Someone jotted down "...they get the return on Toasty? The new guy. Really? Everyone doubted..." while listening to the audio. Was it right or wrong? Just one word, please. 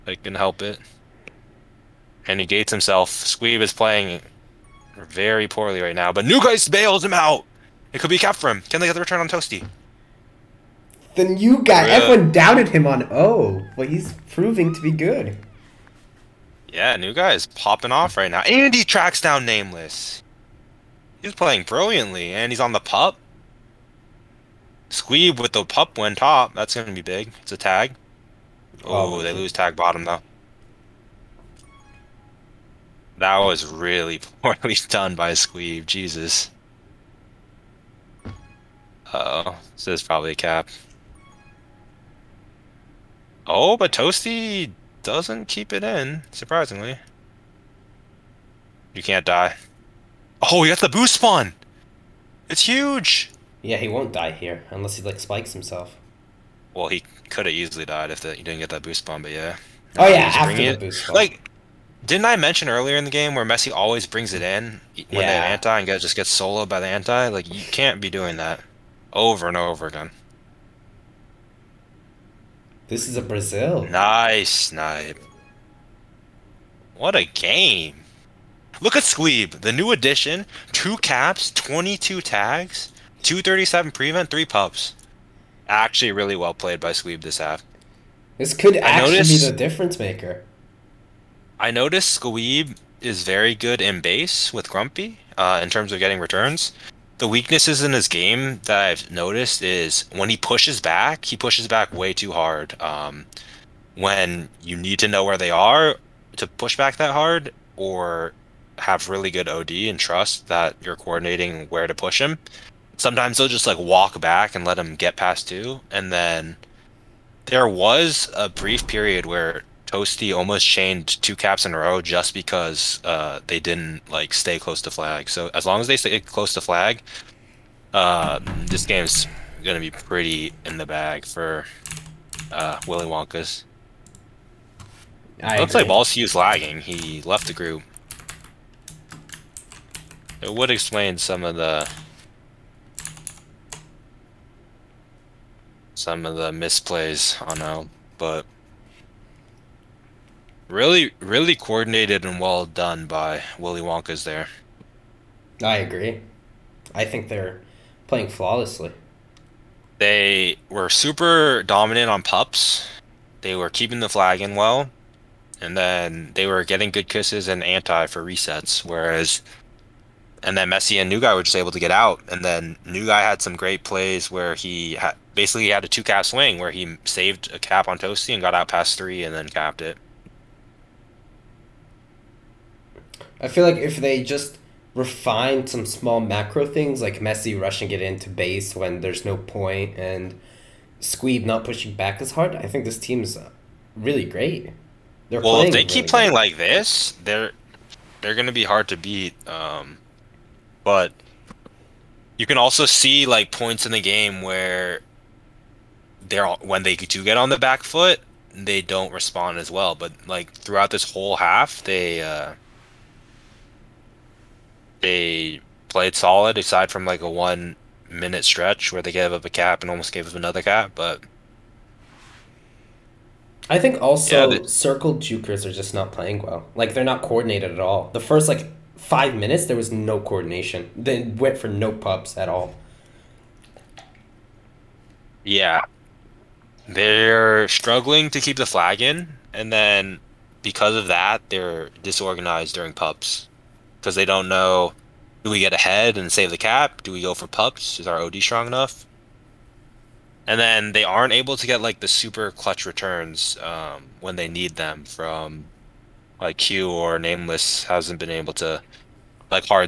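right.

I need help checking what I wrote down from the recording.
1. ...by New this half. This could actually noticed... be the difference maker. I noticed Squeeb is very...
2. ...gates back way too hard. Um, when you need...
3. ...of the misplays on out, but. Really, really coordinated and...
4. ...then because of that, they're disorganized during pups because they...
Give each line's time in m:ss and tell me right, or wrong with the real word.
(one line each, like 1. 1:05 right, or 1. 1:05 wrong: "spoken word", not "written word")
1. 1:26 wrong: "Squeeb", not "New"
2. 1:41 wrong: "pushes", not "gates"
3. 2:26 right
4. 3:59 right.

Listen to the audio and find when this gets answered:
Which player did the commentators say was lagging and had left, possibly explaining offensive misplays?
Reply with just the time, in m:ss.
2:15.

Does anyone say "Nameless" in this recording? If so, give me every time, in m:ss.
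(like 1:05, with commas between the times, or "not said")
0:19, 4:17.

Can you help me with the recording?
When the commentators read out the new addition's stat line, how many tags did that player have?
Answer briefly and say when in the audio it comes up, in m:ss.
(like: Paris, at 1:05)
22, at 1:21.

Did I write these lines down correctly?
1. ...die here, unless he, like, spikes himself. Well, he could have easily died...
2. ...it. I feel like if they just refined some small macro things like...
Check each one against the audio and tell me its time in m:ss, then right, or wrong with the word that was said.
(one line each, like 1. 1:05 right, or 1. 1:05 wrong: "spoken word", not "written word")
1. 0:54 right
2. 2:59 right.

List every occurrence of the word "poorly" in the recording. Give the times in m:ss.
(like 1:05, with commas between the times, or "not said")
0:05, 0:34.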